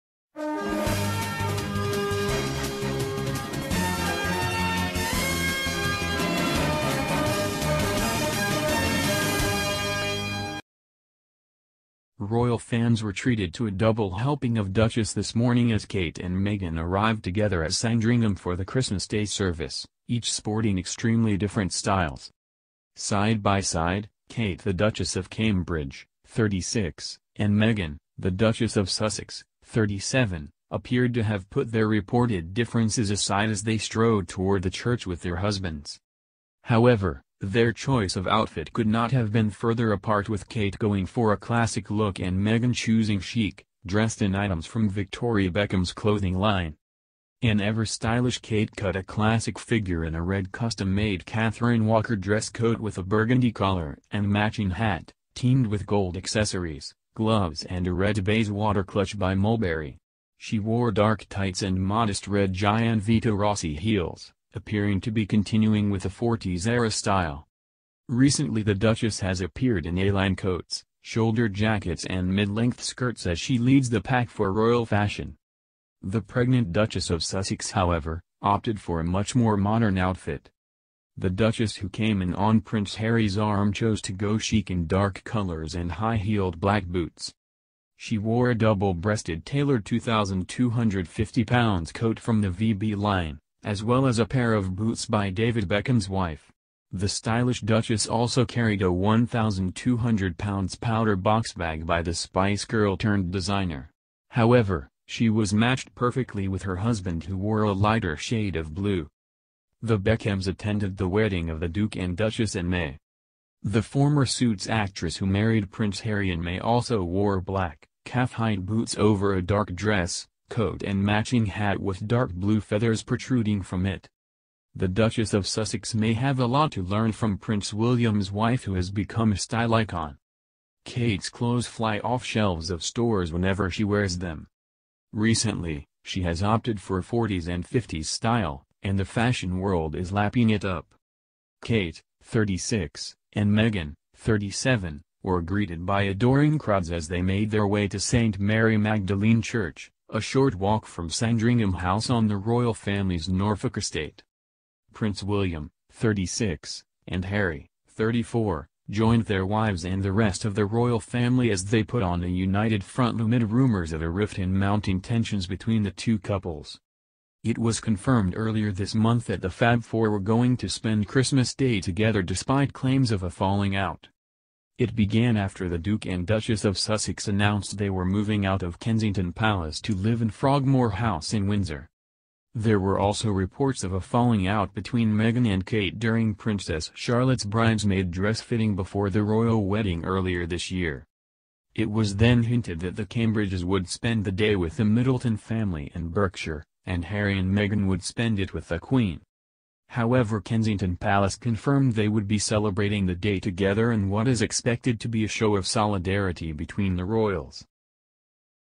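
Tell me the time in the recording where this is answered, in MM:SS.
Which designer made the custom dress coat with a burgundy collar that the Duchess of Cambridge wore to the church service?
00:51.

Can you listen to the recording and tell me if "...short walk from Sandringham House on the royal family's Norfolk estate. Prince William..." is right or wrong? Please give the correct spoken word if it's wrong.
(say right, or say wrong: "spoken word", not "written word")
right.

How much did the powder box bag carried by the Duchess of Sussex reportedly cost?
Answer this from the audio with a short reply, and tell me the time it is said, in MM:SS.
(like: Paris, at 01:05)
£1,200, at 01:38.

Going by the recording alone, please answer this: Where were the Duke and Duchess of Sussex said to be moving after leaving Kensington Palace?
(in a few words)
Frogmore House.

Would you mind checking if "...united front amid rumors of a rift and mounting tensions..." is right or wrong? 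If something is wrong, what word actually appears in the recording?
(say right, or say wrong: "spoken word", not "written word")
right.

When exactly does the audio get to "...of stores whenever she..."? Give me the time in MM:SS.
02:12.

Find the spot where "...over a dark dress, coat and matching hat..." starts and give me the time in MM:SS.
01:58.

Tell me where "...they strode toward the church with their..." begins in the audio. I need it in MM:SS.
00:33.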